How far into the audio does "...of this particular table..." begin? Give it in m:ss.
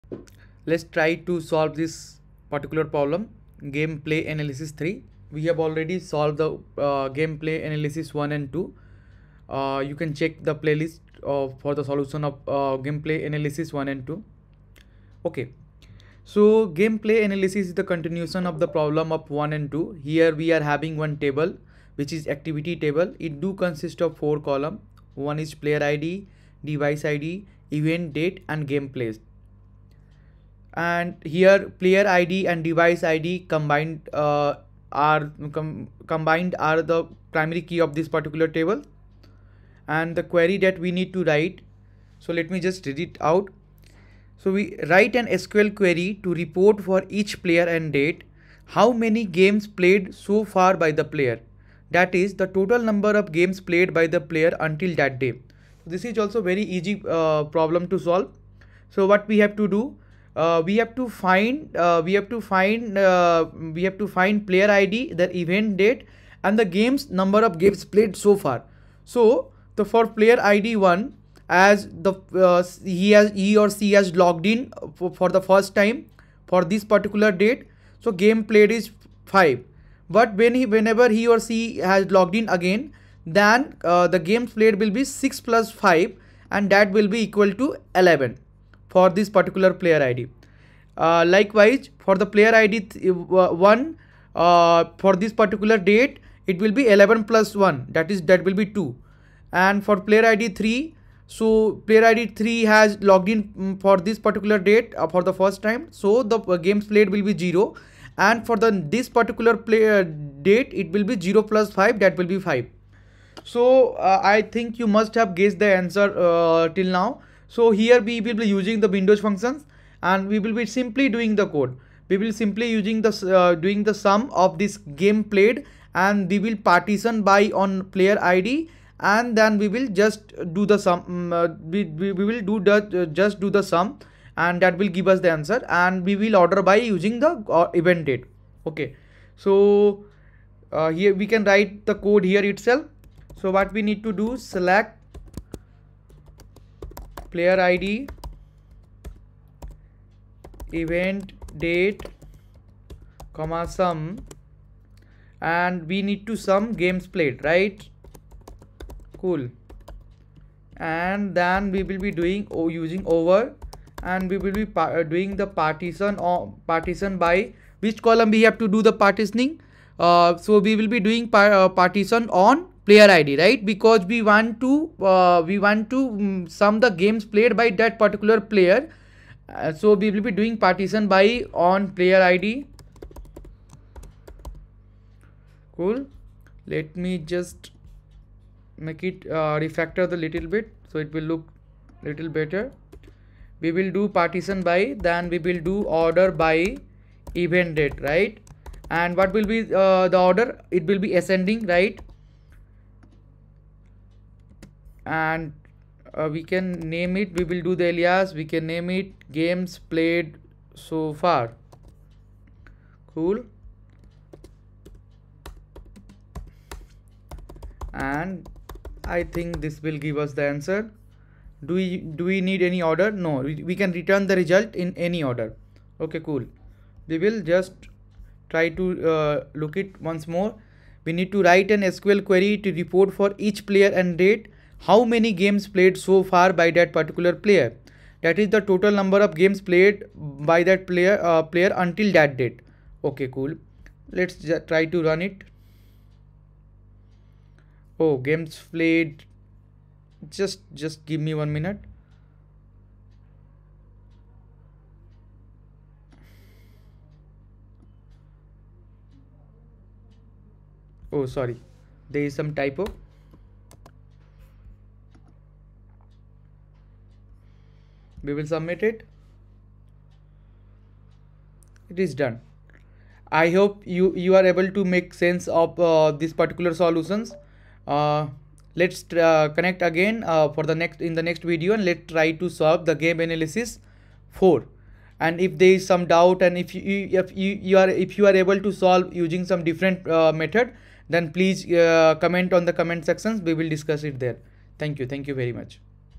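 0:37.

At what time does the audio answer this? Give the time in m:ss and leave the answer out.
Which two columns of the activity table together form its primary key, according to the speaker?
0:31.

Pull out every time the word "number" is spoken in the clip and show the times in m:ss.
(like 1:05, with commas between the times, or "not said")
0:52, 1:07, 3:58.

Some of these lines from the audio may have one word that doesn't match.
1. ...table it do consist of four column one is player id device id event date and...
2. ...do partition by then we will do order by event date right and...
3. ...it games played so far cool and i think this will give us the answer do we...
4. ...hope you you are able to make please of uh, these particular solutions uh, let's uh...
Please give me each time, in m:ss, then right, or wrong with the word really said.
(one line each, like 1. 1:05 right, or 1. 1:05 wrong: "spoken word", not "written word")
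1. 0:22 right
2. 3:13 right
3. 3:28 right
4. 4:33 wrong: "sense", not "please".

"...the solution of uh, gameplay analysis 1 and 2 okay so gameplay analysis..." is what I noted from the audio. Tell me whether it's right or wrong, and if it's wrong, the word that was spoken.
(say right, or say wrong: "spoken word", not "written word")
right.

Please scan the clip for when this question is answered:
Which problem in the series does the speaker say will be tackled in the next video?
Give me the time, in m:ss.
4:43.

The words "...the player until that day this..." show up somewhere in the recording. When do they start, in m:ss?
0:54.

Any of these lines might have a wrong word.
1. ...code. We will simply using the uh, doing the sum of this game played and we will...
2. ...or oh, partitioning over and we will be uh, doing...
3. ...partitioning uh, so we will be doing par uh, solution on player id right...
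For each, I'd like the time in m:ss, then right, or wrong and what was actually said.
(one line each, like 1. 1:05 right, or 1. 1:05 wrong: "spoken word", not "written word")
1. 2:01 right
2. 2:42 wrong: "using", not "partitioning"
3. 2:48 wrong: "partition", not "solution".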